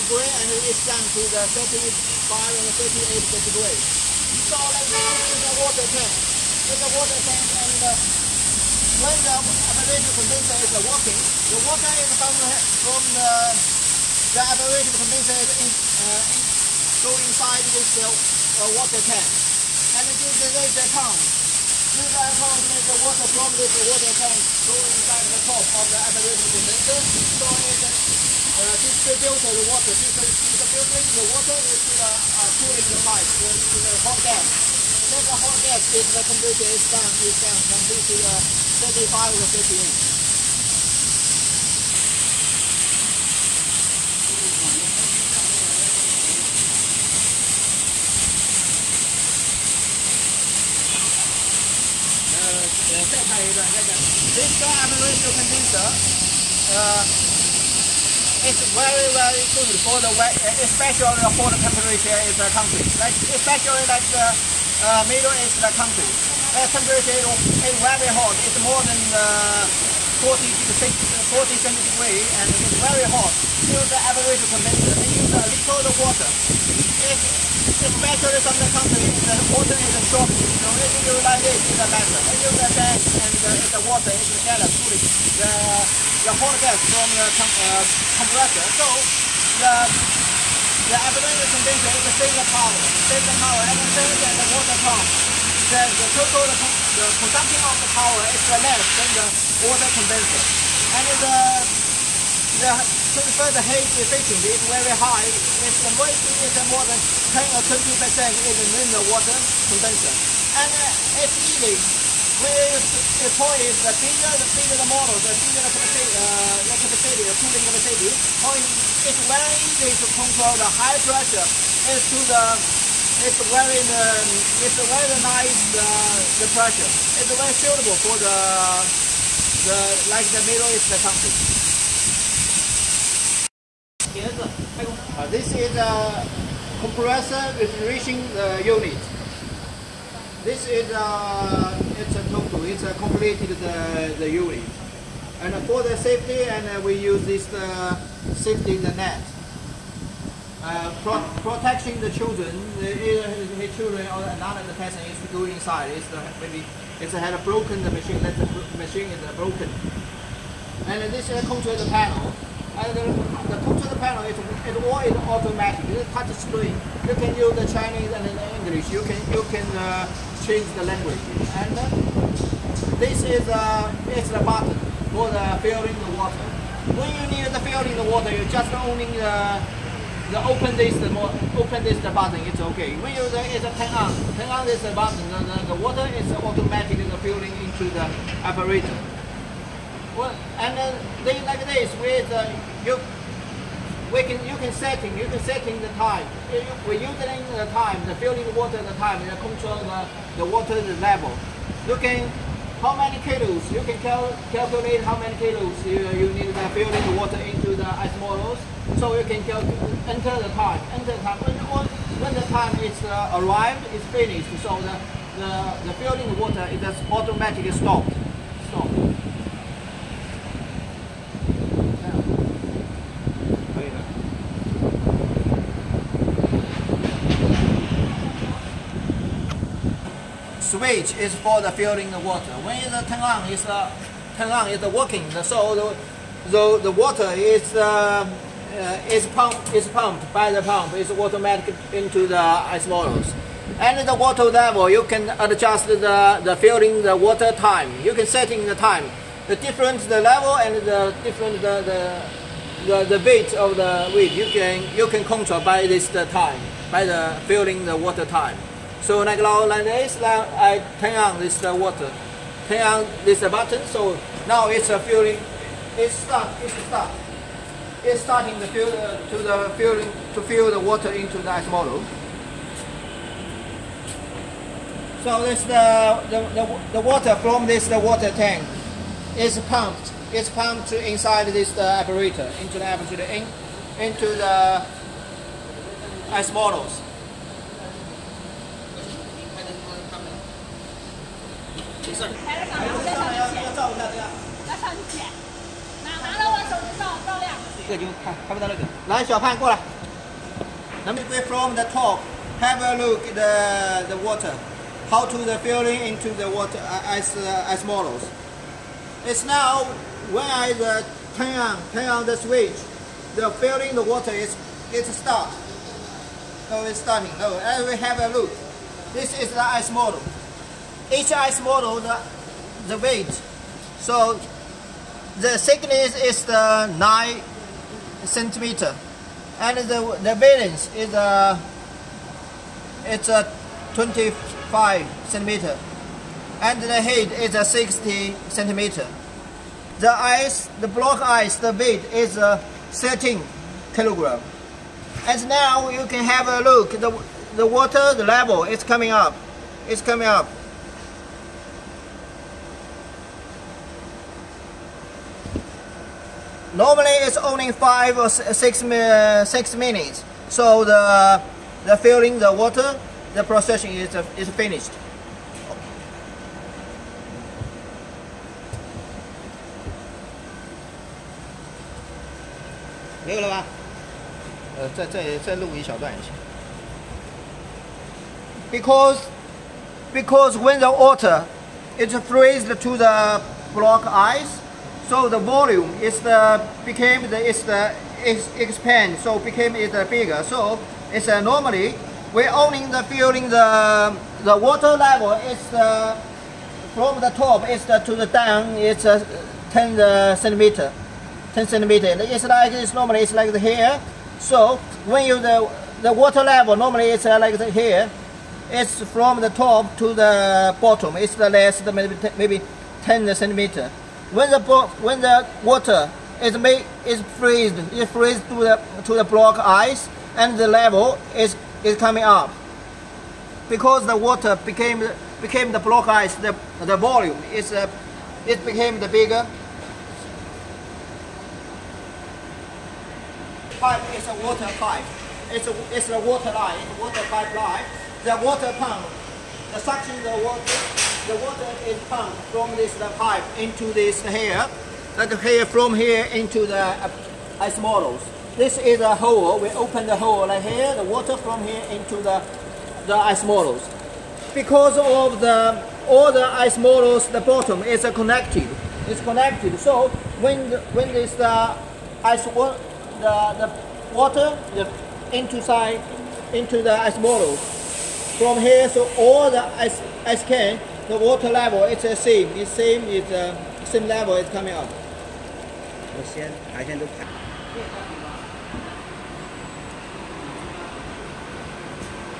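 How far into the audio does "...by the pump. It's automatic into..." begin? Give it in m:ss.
4:00.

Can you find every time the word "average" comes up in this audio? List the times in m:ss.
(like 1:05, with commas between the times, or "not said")
1:14.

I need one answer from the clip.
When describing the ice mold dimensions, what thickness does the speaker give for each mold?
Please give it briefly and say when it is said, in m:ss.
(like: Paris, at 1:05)
9 centimeters, at 5:26.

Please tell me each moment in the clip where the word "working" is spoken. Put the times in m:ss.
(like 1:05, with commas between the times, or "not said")
0:10, 3:54.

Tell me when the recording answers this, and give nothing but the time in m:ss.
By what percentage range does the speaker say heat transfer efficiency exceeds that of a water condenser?
1:47.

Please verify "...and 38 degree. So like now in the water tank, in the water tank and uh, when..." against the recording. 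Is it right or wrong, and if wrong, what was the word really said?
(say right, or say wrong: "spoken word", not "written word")
right.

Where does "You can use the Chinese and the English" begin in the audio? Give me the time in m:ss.
2:47.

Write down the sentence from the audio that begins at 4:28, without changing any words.
It's starting to fill uh, to the filling to fill the water into the ice model.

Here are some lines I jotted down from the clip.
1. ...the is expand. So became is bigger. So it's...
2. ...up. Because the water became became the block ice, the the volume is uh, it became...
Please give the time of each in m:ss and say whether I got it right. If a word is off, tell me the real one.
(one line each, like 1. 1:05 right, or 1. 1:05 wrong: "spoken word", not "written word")
1. 6:27 right
2. 7:02 right.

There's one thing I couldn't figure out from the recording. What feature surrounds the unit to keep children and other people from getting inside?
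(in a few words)
safety net.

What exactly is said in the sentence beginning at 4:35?
So this the uh, the, the, the water from this the water tank is pumped.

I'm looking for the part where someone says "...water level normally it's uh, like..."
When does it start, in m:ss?
6:46.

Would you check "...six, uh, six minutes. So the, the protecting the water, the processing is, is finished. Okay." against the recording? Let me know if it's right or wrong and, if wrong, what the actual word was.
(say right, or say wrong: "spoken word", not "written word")
wrong: "filling", not "protecting".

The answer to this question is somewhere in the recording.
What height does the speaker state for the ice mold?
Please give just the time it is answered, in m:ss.
5:37.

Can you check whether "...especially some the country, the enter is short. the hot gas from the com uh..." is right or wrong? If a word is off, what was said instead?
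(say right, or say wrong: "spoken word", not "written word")
wrong: "water", not "enter".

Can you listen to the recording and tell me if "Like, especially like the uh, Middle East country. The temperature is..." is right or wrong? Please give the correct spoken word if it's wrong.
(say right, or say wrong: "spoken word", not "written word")
right.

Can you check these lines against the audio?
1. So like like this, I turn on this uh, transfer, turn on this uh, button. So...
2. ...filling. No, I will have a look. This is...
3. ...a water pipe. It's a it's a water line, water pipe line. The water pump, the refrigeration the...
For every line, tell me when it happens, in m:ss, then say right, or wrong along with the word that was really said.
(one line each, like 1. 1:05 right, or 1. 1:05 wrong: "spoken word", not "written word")
1. 4:19 wrong: "water", not "transfer"
2. 5:16 wrong: "starting", not "filling"
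3. 7:14 wrong: "suction", not "refrigeration".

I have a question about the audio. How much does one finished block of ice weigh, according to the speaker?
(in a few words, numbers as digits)
13 kilograms.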